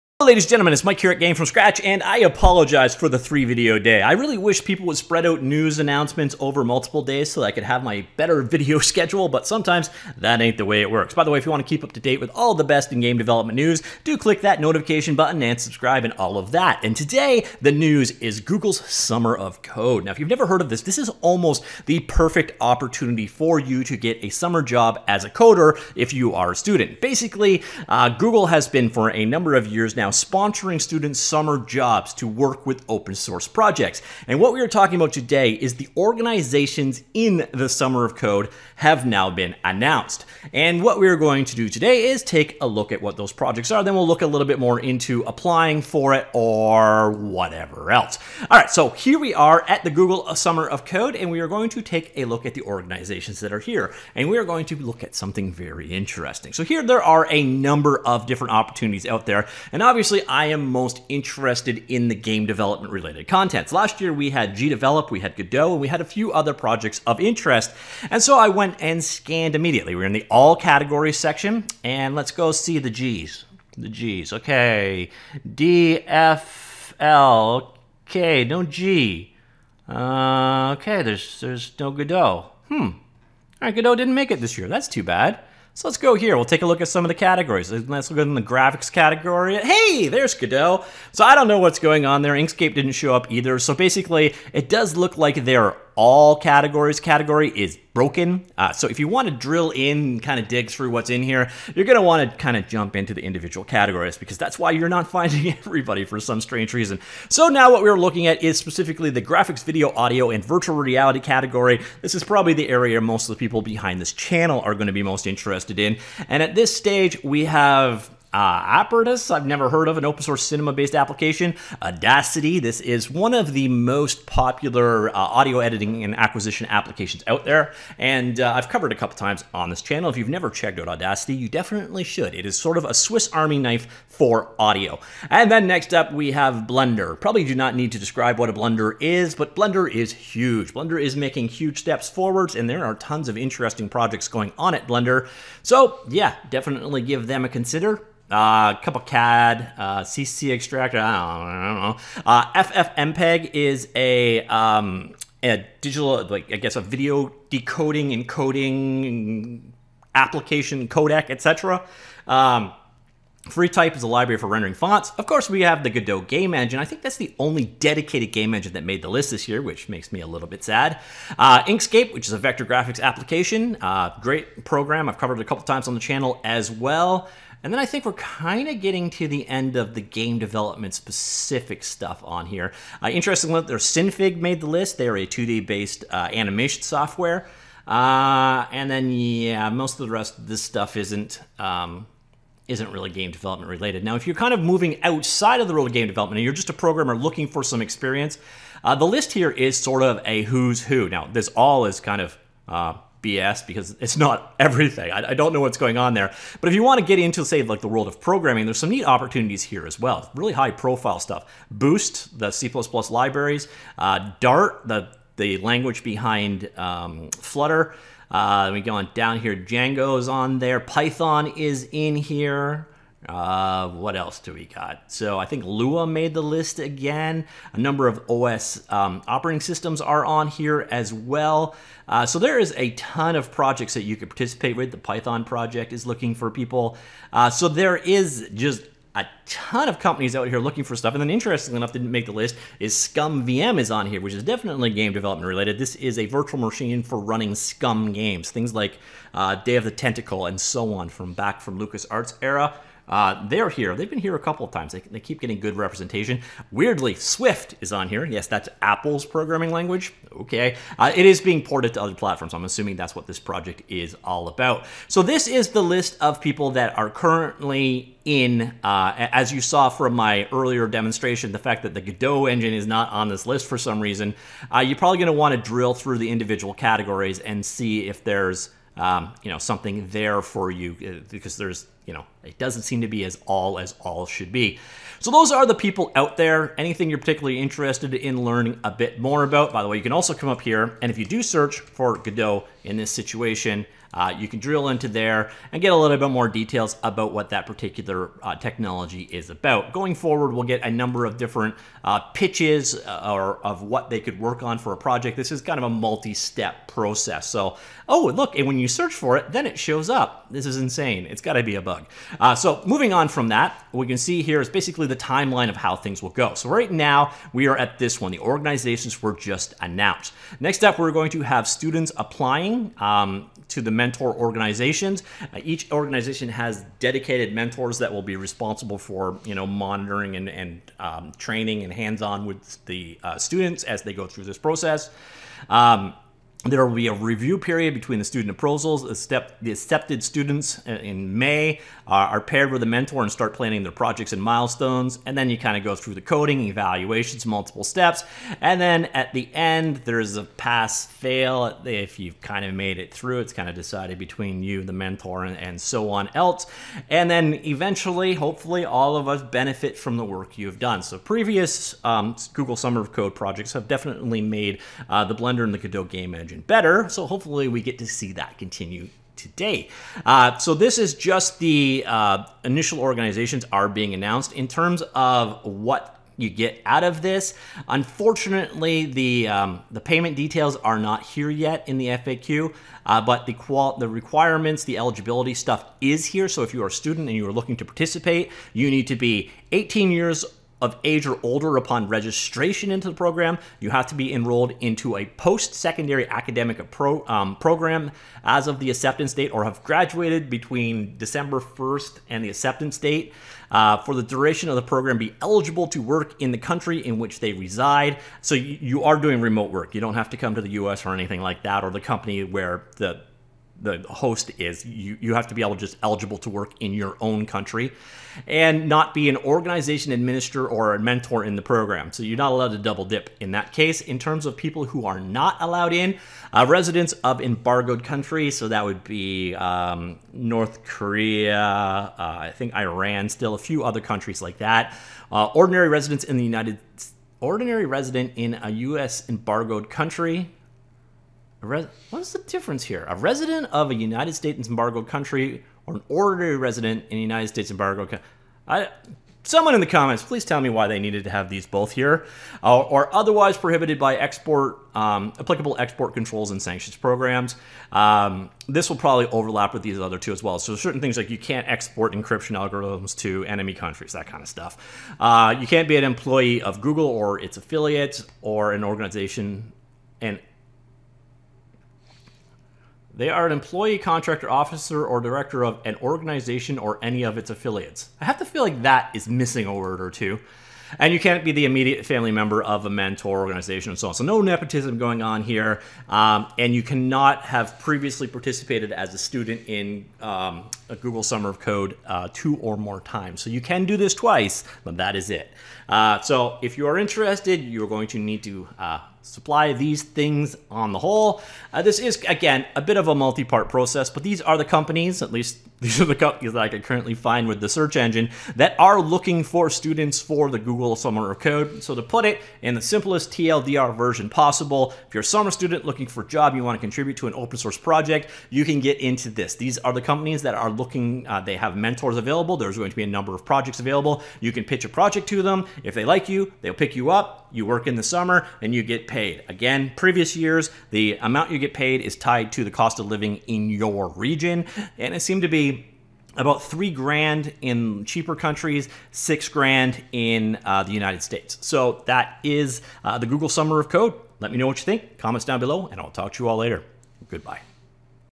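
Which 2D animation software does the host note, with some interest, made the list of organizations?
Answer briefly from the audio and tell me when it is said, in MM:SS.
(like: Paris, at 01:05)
Synfig, at 03:03.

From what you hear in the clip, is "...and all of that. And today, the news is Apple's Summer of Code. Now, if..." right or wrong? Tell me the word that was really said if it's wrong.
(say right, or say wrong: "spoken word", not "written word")
wrong: "Google", not "Apple".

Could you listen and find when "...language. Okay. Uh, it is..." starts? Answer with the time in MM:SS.
04:19.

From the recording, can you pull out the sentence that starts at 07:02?
So you're not allowed to double dip in that case.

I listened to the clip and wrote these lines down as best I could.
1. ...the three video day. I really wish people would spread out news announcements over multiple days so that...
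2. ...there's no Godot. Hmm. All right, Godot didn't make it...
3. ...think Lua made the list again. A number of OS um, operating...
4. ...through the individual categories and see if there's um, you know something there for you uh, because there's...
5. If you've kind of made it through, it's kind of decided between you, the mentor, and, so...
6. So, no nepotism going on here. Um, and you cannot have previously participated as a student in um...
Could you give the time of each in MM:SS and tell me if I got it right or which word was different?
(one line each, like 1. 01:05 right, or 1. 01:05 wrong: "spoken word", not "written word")
1. 00:03 right
2. 01:21 right
3. 03:45 right
4. 04:35 right
5. 05:51 right
6. 08:04 right.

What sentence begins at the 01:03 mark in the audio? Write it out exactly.
Last year we had GDevelop, we had Godot, and we had a few other projects of interest.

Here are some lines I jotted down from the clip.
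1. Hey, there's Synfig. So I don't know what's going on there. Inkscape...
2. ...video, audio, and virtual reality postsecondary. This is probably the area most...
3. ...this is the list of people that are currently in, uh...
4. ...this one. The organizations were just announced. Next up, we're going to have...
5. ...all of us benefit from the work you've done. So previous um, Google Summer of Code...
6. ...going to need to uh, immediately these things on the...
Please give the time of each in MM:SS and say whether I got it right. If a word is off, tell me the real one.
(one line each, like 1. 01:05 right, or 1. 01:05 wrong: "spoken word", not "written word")
1. 01:29 wrong: "Godot", not "Synfig"
2. 01:49 wrong: "category", not "postsecondary"
3. 04:25 right
4. 05:17 right
5. 05:58 right
6. 08:17 wrong: "supply", not "immediately".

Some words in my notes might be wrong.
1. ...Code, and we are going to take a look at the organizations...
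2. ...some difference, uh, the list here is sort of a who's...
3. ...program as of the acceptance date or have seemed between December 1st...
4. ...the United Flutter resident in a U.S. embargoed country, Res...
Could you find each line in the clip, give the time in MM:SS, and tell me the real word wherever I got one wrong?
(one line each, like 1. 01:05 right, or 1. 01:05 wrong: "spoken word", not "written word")
1. 00:50 right
2. 03:17 wrong: "experience", not "difference"
3. 06:37 wrong: "graduated", not "seemed"
4. 07:16 wrong: "Ordinary", not "Flutter".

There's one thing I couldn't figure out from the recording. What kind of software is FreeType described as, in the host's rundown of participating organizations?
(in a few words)
Library for rendering fonts.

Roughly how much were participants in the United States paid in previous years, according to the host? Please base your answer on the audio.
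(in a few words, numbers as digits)
6 grand.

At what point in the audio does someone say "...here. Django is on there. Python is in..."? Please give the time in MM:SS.
03:39.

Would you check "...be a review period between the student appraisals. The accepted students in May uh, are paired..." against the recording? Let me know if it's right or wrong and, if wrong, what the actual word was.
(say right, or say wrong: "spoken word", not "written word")
right.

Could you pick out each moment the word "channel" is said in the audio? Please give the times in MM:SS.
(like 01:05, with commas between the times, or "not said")
01:54, 02:09, 02:55.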